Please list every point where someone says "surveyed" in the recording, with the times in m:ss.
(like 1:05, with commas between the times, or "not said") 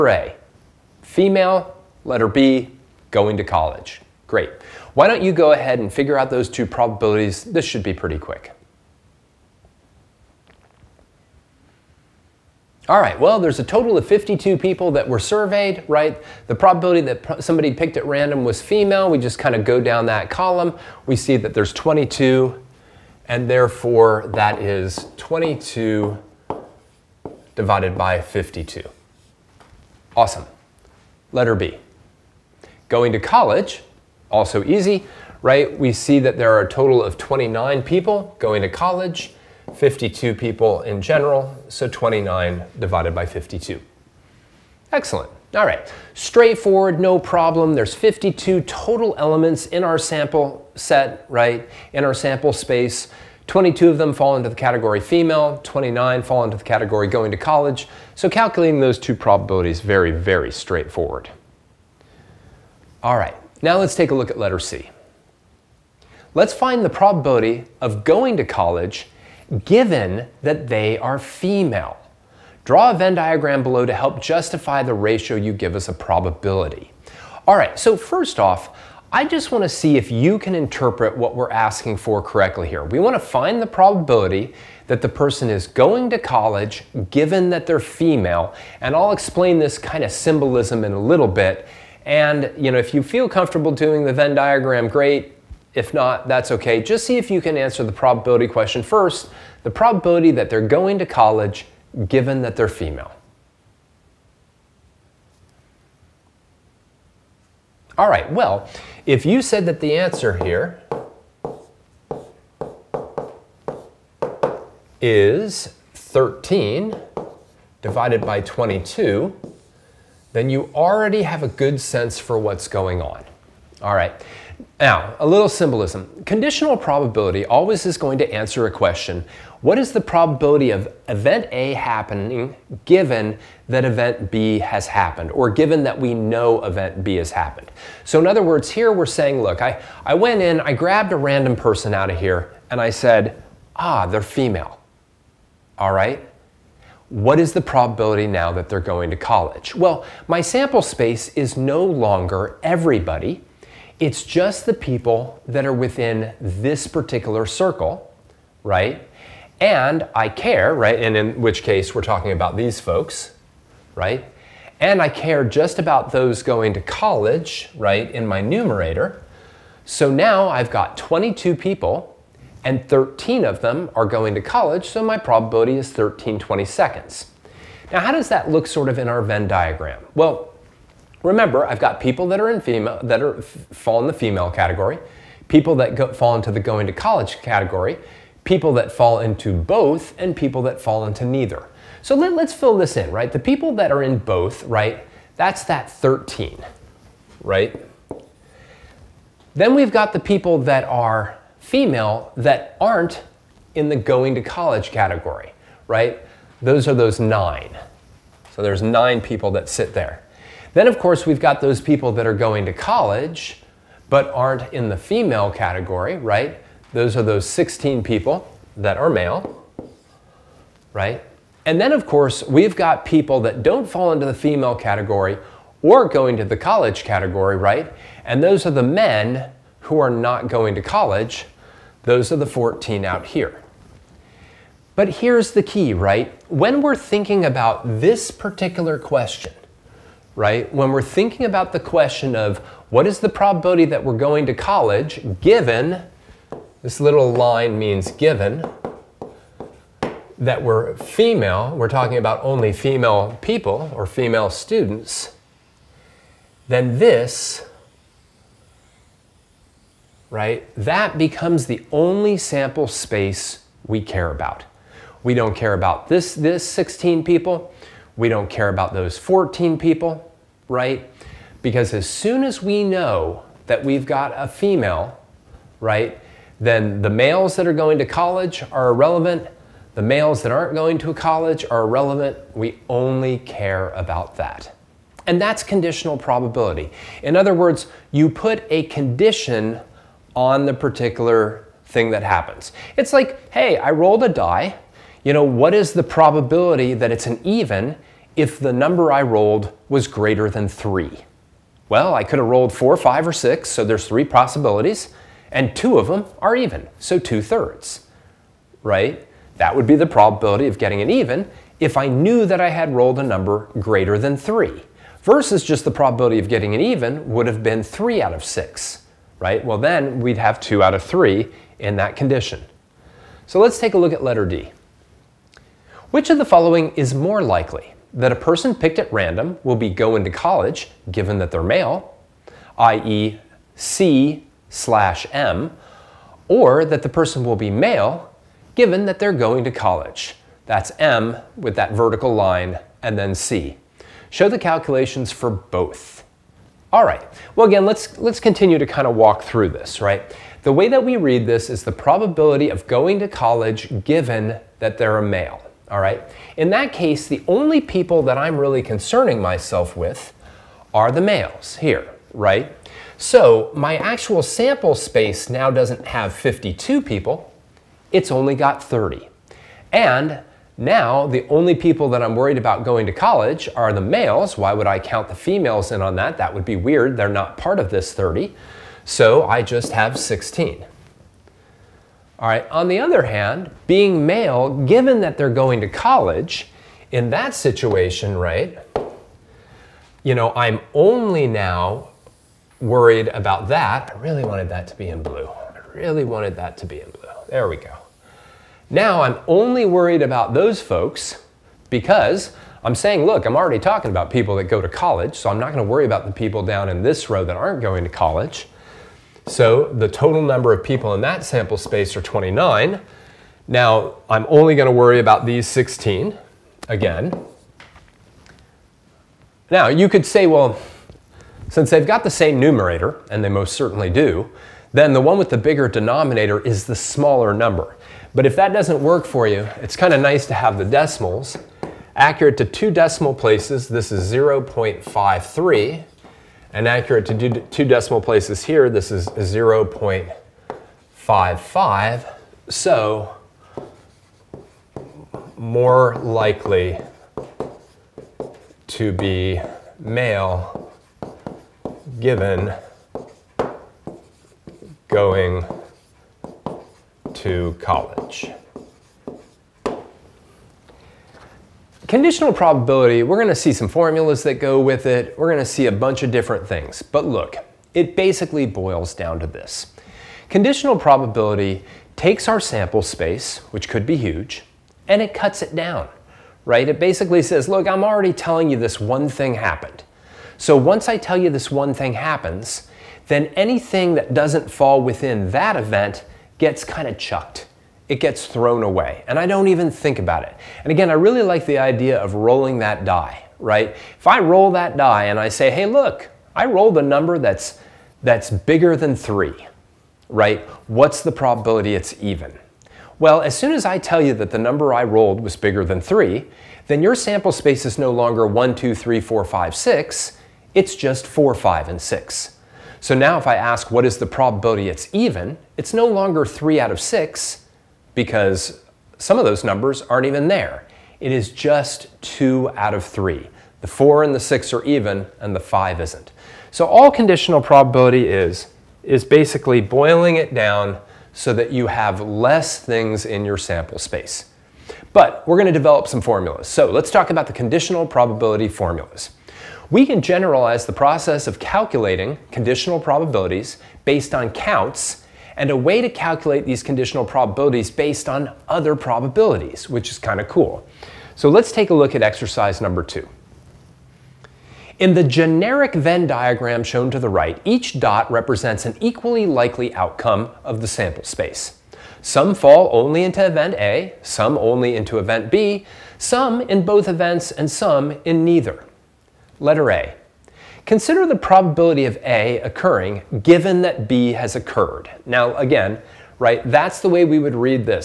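0:15.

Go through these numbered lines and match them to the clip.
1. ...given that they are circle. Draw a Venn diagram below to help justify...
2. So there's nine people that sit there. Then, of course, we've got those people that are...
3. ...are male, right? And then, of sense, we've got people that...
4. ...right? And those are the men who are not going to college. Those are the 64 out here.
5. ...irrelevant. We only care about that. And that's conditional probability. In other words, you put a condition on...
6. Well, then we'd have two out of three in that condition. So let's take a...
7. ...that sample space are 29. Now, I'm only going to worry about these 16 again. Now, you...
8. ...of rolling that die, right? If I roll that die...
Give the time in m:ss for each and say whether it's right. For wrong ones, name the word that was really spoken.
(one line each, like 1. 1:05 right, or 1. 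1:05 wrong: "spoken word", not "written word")
1. 1:09 wrong: "female", not "circle"
2. 3:28 right
3. 3:38 wrong: "course", not "sense"
4. 3:47 wrong: "14", not "64"
5. 4:41 right
6. 5:19 right
7. 6:51 right
8. 8:12 right.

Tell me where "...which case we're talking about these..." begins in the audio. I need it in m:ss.
2:41.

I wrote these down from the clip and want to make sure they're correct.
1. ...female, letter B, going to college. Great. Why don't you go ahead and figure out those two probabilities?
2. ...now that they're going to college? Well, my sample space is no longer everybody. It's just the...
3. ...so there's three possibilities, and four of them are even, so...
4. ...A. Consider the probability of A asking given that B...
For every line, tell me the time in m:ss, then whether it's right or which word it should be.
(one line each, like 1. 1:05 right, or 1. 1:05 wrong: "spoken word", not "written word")
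1. 0:01 right
2. 2:28 right
3. 5:03 wrong: "two", not "four"
4. 9:29 wrong: "occurring", not "asking".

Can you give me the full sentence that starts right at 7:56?
It basically says, look, I'm already telling you this one thing happened.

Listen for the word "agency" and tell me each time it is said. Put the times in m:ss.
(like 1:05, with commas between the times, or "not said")
not said.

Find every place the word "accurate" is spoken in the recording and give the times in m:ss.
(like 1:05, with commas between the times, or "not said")
7:12, 7:16.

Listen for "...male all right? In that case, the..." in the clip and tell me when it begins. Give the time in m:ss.
5:55.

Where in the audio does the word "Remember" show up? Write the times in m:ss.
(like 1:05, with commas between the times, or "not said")
3:01.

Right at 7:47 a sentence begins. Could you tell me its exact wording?
But look, it basically boils down to this.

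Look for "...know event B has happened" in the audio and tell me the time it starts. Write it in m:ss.
2:16.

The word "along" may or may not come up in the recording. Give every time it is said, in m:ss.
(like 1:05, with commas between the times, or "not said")
not said.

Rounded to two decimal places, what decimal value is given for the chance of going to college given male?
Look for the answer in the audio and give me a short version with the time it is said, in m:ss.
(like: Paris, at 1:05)
0.53, at 7:14.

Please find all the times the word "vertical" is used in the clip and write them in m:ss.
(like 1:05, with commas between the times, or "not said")
5:41.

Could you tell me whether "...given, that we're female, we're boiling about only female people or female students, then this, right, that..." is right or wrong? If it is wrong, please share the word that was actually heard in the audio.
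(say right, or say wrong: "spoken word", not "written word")
wrong: "talking", not "boiling".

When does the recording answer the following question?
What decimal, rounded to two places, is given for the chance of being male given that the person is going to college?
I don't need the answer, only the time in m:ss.
7:19.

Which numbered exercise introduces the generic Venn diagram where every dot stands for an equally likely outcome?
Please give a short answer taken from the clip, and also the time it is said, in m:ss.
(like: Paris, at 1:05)
2, at 9:12.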